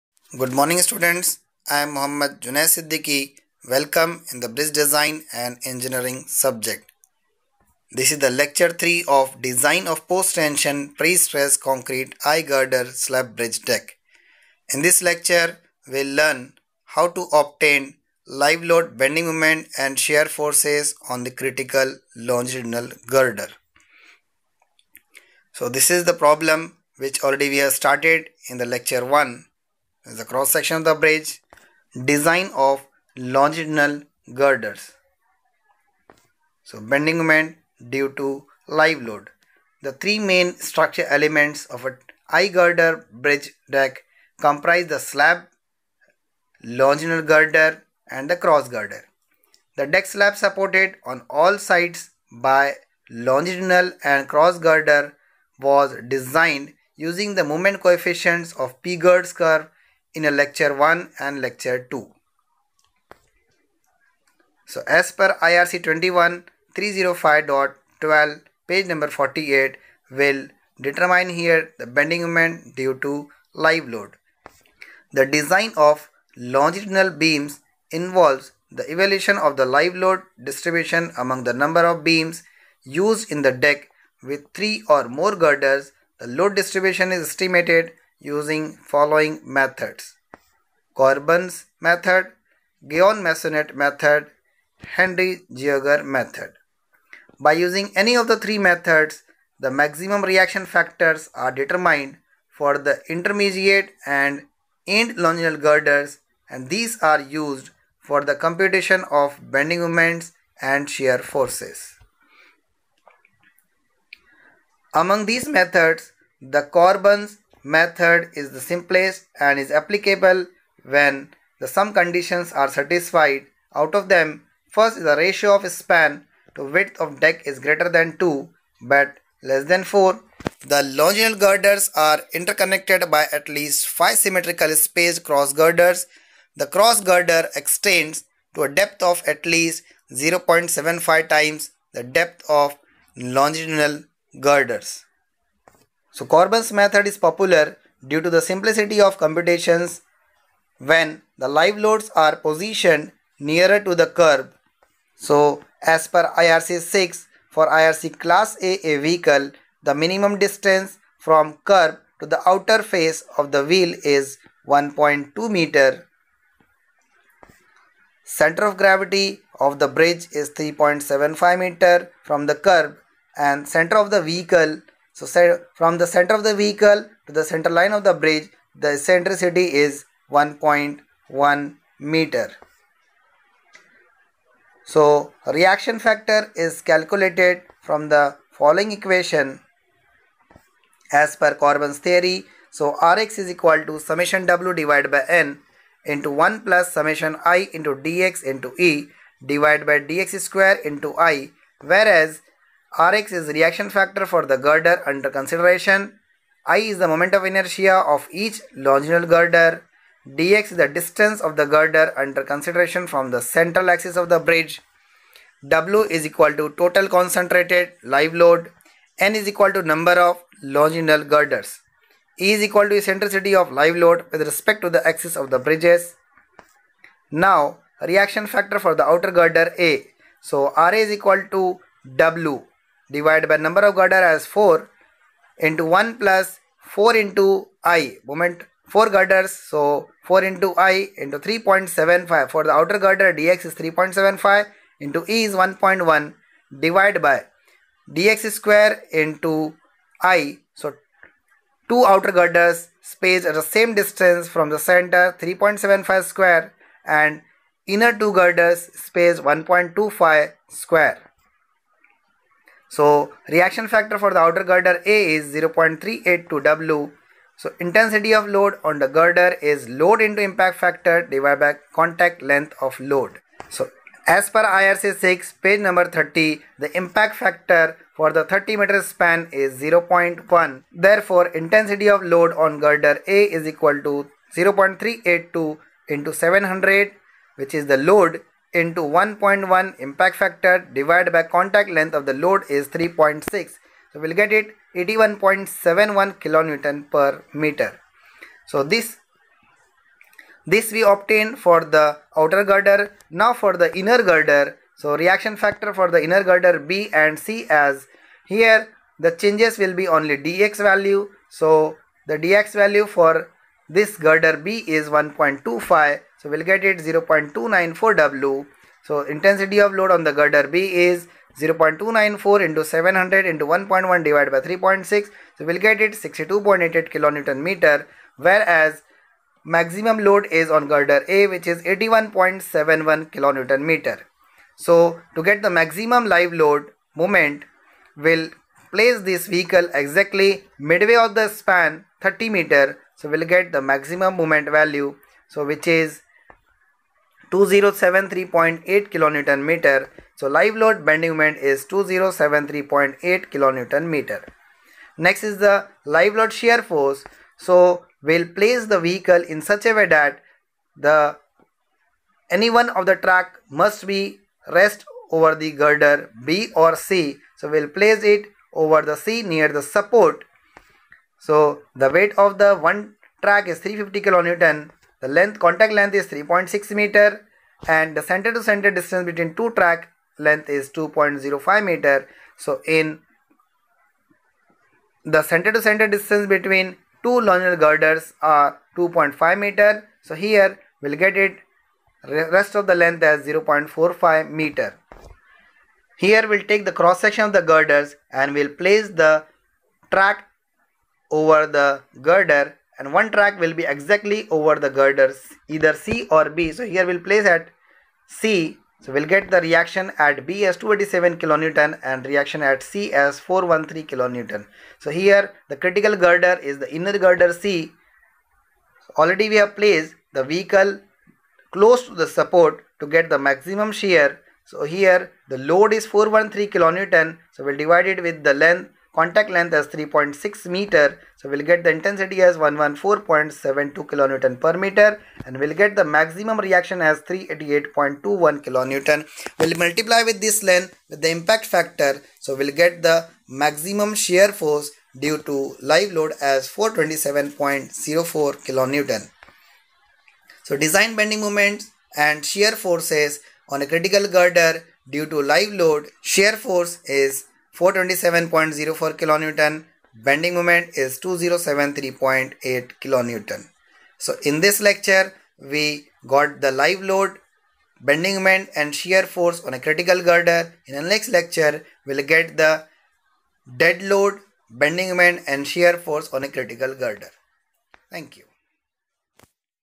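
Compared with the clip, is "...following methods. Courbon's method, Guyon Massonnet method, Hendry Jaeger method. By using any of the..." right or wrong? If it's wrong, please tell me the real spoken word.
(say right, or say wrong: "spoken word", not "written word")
right.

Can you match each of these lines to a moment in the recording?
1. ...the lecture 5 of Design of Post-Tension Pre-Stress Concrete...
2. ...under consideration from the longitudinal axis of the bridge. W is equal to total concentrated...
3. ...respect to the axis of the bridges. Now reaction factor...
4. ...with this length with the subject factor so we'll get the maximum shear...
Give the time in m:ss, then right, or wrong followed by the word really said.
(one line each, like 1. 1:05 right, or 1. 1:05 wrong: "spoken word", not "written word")
1. 0:08 wrong: "3", not "5"
2. 3:32 wrong: "central", not "longitudinal"
3. 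3:44 right
4. 7:20 wrong: "impact", not "subject".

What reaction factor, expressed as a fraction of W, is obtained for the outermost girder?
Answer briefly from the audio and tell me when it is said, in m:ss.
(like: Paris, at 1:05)
0.382 W, at 4:25.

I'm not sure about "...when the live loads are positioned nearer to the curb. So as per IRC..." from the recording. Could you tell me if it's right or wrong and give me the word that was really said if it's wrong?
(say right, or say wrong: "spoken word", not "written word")
right.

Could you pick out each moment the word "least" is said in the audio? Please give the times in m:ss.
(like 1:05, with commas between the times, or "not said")
2:13, 2:19.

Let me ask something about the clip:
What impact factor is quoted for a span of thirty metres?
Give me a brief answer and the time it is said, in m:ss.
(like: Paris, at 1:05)
0.1, at 4:39.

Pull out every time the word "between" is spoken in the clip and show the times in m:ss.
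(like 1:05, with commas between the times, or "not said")
6:19, 6:26.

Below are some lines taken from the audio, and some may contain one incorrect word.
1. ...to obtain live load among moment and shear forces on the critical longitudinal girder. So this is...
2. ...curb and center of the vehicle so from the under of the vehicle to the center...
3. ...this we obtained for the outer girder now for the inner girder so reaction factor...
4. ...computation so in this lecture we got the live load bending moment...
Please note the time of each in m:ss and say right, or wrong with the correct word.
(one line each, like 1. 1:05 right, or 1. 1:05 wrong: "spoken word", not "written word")
1. 0:17 wrong: "bending", not "among"
2. 2:52 wrong: "center", not "under"
3. 5:00 right
4. 7:43 wrong: "kilonewton", not "computation".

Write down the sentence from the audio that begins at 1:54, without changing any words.
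Among these methods, the Courbon's method is the simplest and is applicable when the sum conditions are satisfied.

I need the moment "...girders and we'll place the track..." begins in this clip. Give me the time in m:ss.
6:37.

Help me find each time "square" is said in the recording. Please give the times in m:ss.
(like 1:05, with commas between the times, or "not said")
3:20, 4:08, 4:16, 4:20.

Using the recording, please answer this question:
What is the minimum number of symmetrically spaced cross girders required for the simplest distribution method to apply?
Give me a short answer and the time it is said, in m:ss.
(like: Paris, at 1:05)
5, at 2:13.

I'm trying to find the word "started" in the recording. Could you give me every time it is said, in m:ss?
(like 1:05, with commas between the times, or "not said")
0:27.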